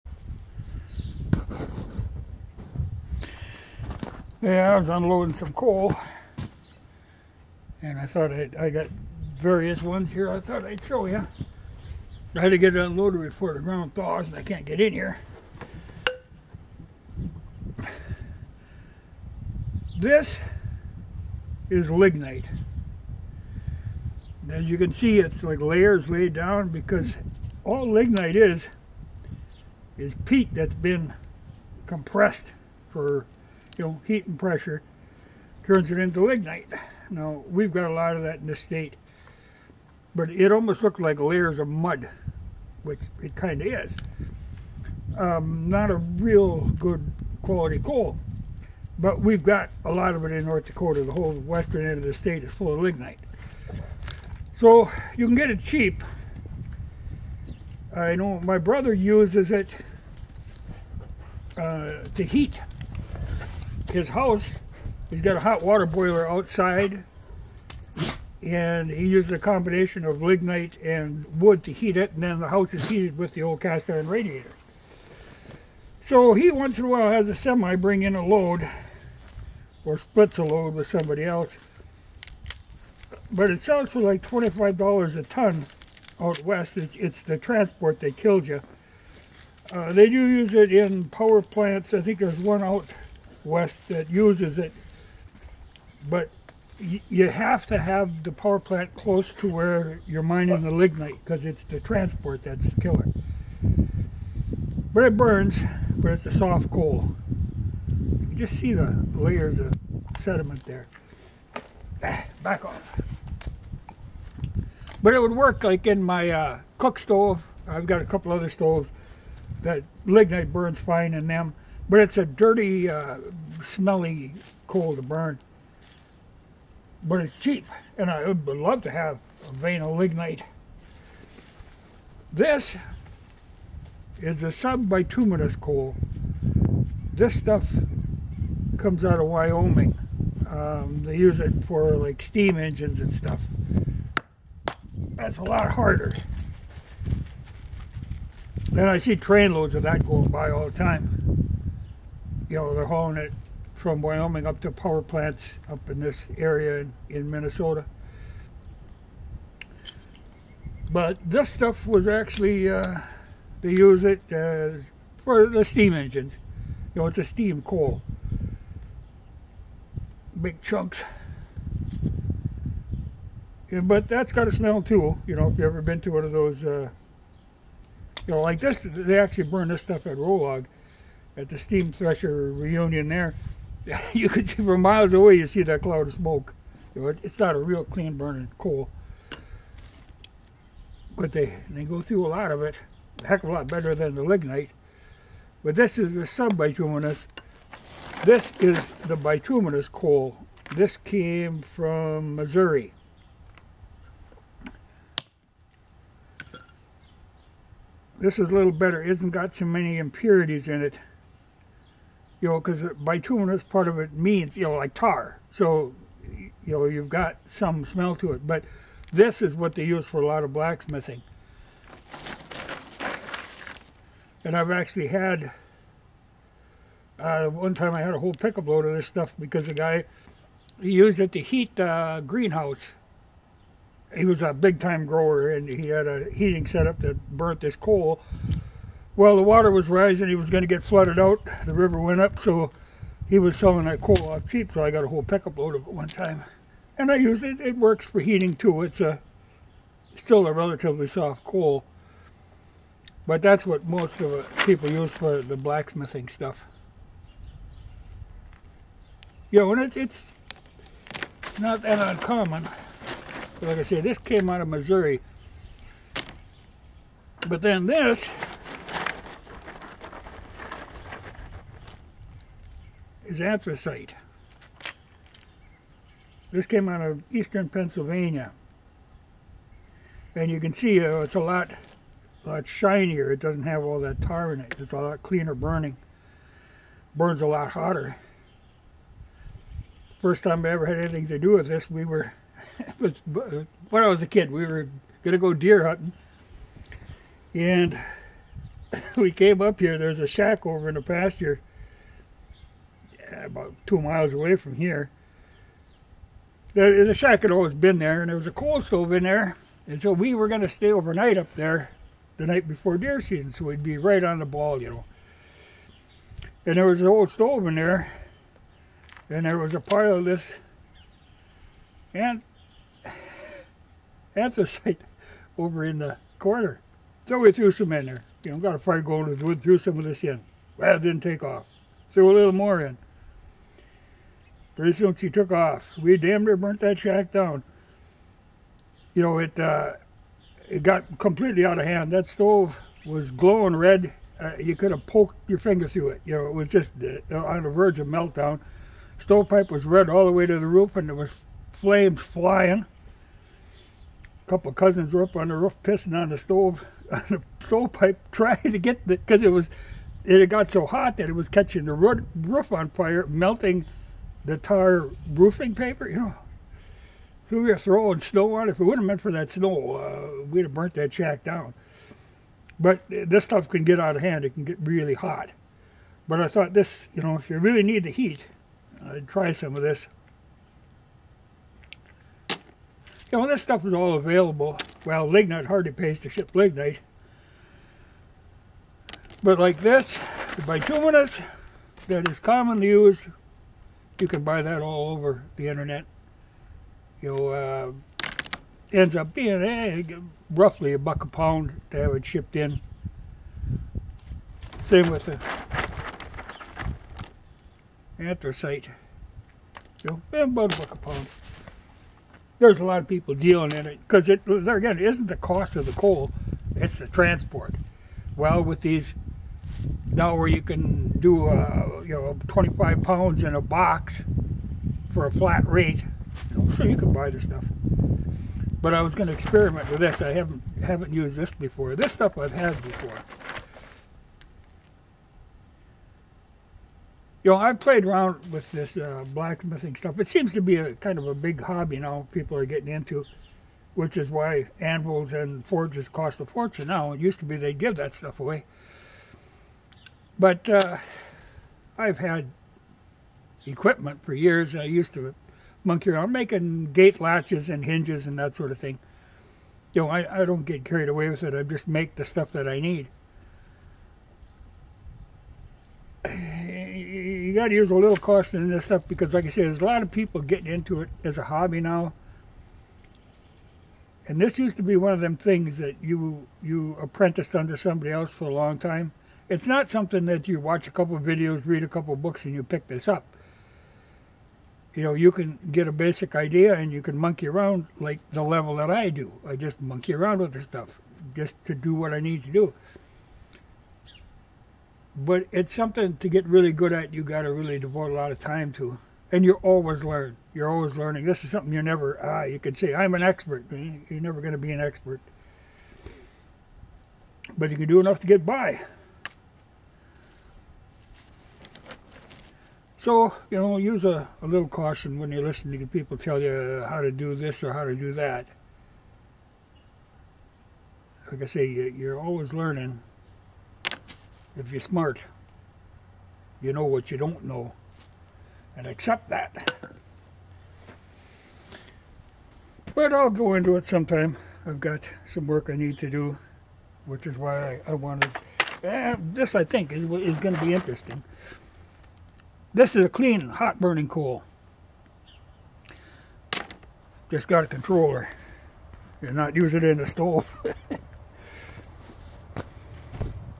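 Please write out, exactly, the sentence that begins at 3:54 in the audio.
He was a big time grower and he had a heating setup that burnt this coal well, the water was rising.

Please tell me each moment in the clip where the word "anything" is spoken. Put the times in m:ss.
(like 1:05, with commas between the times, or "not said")
4:50.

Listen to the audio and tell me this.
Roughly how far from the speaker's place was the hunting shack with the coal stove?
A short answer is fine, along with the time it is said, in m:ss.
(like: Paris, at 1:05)
2 miles, at 5:03.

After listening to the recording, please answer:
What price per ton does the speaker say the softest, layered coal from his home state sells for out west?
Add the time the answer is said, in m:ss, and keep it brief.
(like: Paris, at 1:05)
$25, at 1:24.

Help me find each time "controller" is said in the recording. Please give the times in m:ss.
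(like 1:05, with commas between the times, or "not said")
9:07.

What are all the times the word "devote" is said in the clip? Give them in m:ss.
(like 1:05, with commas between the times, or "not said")
8:17.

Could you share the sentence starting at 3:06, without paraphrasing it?
it's not a real clean burning coal.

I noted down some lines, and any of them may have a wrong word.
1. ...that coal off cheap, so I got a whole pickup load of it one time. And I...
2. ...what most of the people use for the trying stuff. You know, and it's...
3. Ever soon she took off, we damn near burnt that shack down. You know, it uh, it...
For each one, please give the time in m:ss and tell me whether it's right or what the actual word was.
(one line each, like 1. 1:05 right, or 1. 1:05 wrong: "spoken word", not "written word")
1. 4:03 right
2. 4:13 wrong: "blacksmithing", not "trying"
3. 5:34 right.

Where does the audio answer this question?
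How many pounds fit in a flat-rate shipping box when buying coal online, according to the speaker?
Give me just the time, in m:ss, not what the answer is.
7:02.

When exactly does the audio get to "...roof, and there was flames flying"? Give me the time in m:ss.
5:50.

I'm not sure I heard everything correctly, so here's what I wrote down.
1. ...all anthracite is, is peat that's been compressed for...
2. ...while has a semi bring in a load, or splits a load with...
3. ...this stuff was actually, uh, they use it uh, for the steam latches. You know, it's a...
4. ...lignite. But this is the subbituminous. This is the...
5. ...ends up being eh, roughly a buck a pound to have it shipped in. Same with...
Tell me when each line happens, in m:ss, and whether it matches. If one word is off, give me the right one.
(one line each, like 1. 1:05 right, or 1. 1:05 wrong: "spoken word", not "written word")
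1. 0:27 wrong: "lignite", not "anthracite"
2. 1:16 right
3. 2:41 wrong: "engines", not "latches"
4. 3:14 right
5. 6:38 right.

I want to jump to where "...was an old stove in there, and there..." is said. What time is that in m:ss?
5:16.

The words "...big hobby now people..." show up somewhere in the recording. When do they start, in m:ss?
7:21.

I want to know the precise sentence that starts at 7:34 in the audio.
I used to monkey around making gate latches and hinges and that sort of thing.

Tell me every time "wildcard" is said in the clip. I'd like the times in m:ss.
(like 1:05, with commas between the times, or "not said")
not said.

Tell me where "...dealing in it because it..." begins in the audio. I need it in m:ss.
6:53.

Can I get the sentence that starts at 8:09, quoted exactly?
I just monkey around with this stuff just to do what I need to do.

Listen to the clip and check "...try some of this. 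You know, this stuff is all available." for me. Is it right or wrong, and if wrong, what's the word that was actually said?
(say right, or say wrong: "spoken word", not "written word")
right.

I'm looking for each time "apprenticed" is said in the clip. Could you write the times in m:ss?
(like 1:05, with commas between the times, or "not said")
7:56.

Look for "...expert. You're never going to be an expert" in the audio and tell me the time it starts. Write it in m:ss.
8:23.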